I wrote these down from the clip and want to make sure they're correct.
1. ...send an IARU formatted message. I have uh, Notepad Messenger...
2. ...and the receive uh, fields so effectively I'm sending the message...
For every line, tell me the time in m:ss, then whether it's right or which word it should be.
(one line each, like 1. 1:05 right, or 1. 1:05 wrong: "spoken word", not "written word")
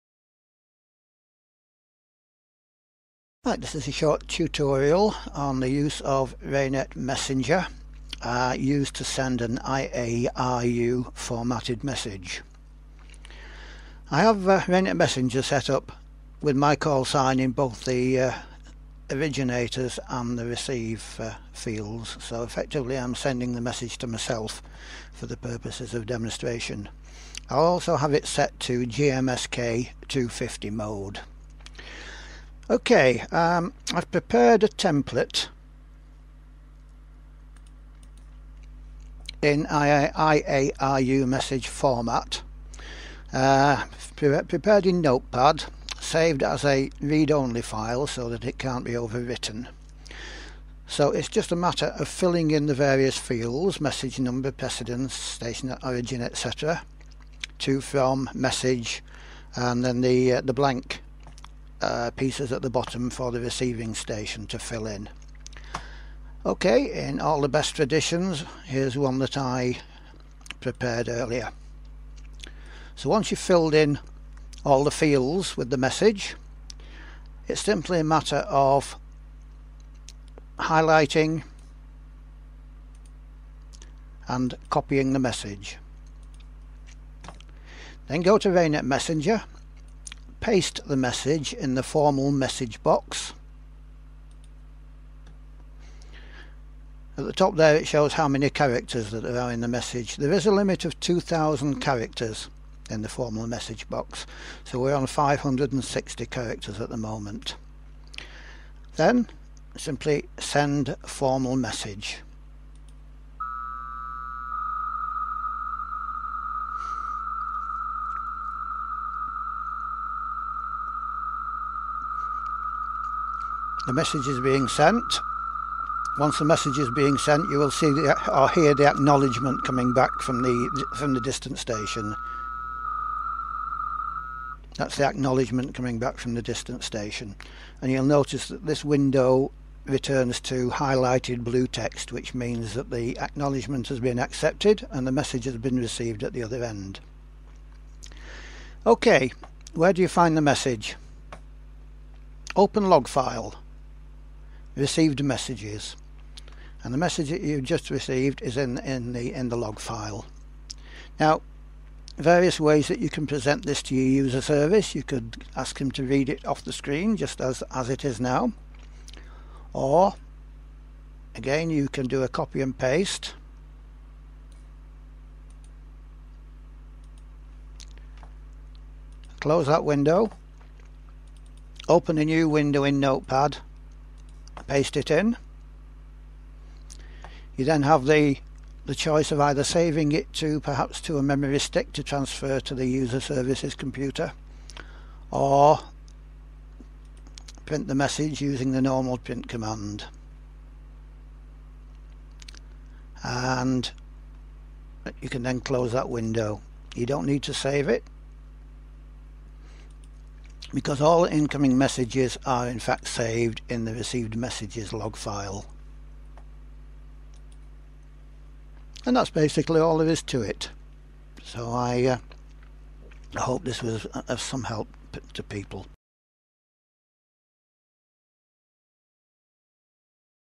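1. 0:09 wrong: "Raynet", not "Notepad"
2. 0:20 right.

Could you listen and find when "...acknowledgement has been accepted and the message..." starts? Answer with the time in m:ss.
2:23.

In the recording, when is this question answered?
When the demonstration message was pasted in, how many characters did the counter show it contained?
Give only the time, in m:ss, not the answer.
1:45.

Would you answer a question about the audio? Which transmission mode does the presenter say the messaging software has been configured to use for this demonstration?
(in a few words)
GMSK 250.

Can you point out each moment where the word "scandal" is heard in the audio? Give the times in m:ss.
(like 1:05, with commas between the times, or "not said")
not said.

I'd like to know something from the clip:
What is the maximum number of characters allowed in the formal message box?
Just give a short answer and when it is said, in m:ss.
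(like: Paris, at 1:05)
2000, at 1:40.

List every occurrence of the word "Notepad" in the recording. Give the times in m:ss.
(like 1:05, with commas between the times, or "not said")
0:45, 3:02.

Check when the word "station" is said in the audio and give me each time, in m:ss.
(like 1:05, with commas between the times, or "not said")
0:55, 1:03, 2:11, 2:16.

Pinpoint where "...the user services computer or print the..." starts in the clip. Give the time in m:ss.
3:12.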